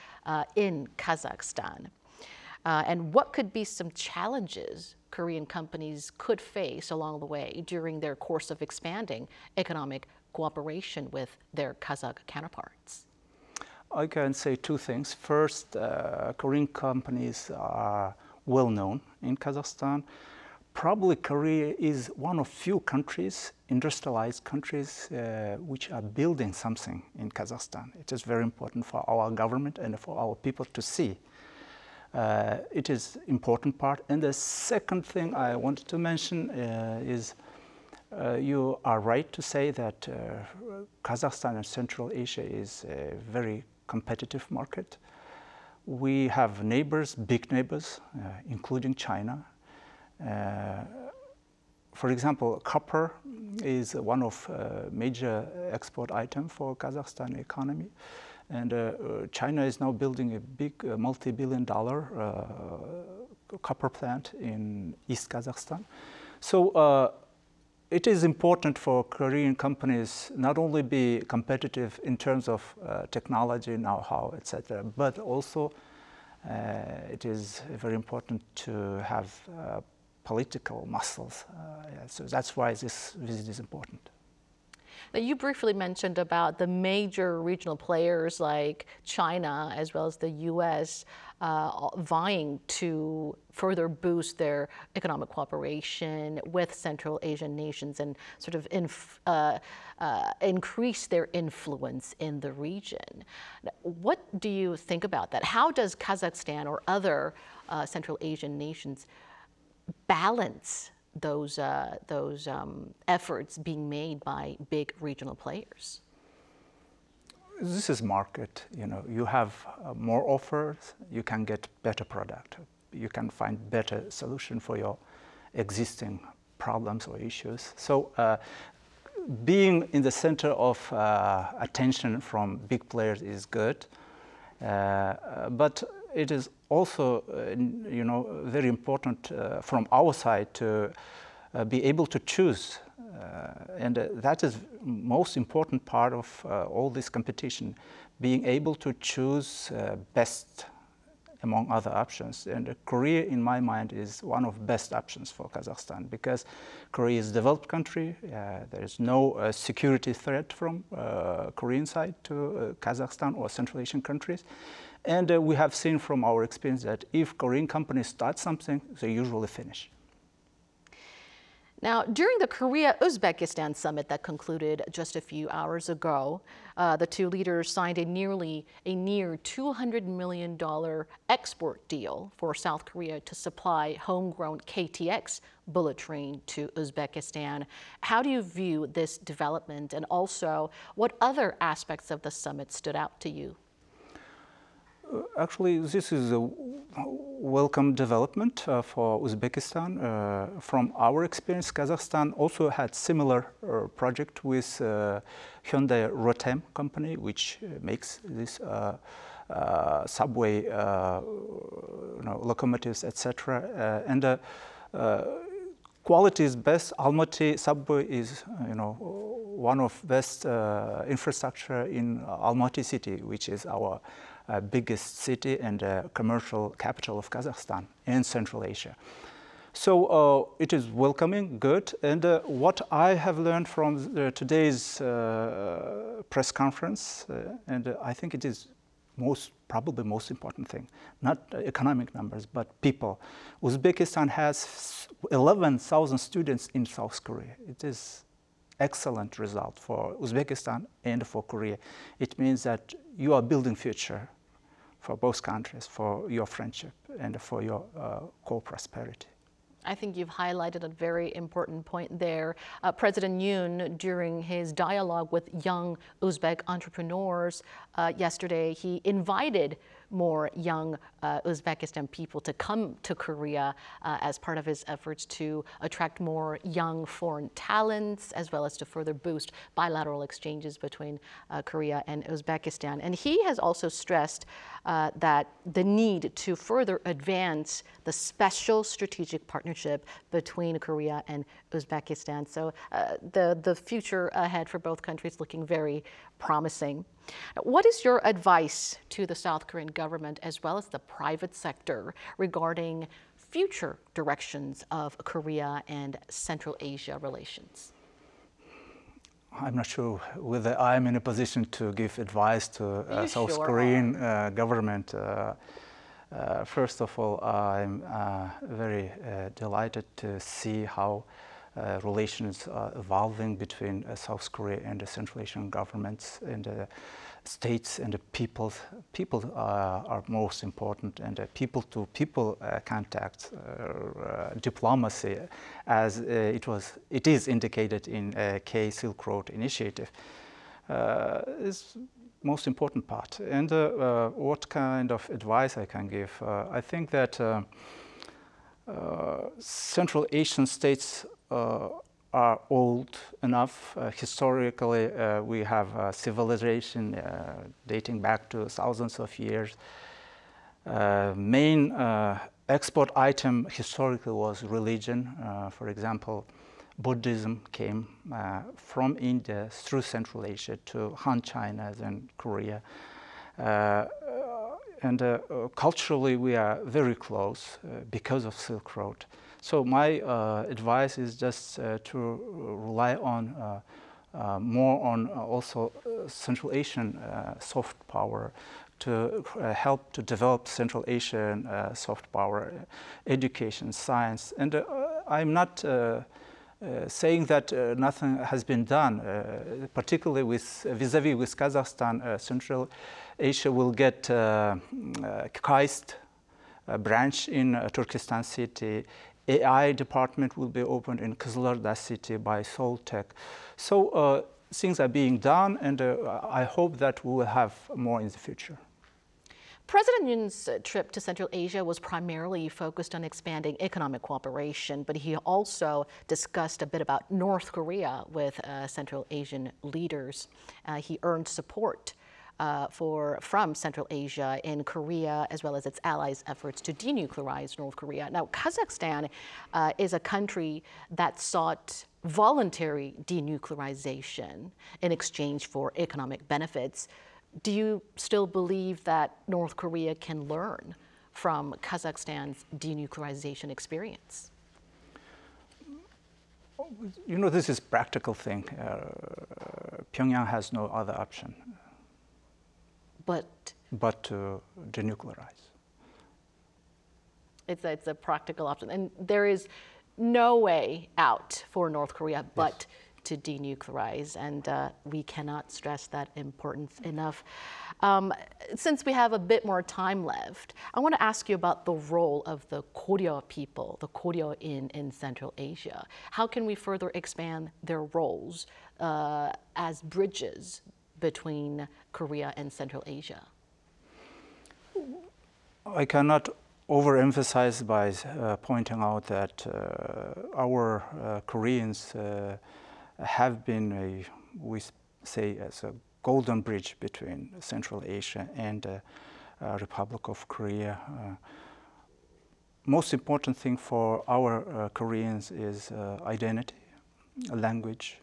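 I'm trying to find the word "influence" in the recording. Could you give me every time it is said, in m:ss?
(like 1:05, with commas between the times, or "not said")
1:41.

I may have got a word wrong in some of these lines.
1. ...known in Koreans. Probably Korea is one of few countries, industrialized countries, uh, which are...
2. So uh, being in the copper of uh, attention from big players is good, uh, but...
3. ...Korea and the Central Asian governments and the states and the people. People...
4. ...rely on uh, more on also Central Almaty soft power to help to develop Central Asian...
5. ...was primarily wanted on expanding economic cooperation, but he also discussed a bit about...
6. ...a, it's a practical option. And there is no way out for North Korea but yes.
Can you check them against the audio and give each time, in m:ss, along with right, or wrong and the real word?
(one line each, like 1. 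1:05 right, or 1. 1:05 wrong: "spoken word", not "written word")
1. 0:18 wrong: "Kazakhstan", not "Koreans"
2. 2:07 wrong: "center", not "copper"
3. 5:24 right
4. 6:22 wrong: "Asian", not "Almaty"
5. 7:01 wrong: "focused", not "wanted"
6. 7:47 right.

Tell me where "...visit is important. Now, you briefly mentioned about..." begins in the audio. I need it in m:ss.
1:23.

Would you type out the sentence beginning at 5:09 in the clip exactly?
I'm not sure whether I'm in a position to give advice to uh, South sure Korean uh, government.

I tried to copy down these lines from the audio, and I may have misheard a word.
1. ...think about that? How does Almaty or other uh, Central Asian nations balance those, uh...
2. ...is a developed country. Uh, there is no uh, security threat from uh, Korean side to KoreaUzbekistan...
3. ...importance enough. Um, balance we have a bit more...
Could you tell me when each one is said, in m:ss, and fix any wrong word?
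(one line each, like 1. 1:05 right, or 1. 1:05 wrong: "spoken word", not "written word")
1. 1:44 wrong: "Kazakhstan", not "Almaty"
2. 2:37 wrong: "Kazakhstan", not "KoreaUzbekistan"
3. 7:56 wrong: "since", not "balance".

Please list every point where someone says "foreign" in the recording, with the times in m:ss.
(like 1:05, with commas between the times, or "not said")
4:37.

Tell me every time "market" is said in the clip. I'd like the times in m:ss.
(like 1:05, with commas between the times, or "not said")
0:44, 1:58.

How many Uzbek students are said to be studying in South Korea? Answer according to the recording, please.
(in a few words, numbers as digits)
11,000.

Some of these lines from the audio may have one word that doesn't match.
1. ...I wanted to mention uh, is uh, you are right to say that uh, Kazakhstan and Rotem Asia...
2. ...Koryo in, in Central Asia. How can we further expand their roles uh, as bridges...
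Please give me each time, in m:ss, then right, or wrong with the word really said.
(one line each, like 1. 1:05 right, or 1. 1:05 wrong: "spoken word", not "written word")
1. 0:35 wrong: "Central", not "Rotem"
2. 8:04 right.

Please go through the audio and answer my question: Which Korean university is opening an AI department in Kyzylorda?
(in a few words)
SeoulTech.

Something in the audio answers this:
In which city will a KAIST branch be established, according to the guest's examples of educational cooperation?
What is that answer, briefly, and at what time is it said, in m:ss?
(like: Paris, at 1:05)
Turkestan, at 6:47.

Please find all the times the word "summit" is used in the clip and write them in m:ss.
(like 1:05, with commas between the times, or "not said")
2:53, 3:12.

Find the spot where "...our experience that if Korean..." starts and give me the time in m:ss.
2:46.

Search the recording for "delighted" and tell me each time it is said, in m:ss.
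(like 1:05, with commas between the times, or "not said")
5:19.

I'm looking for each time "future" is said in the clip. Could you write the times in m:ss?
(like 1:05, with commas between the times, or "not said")
4:13, 4:53, 5:03, 6:58.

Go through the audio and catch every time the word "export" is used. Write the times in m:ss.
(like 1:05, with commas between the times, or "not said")
0:55, 3:01, 6:02.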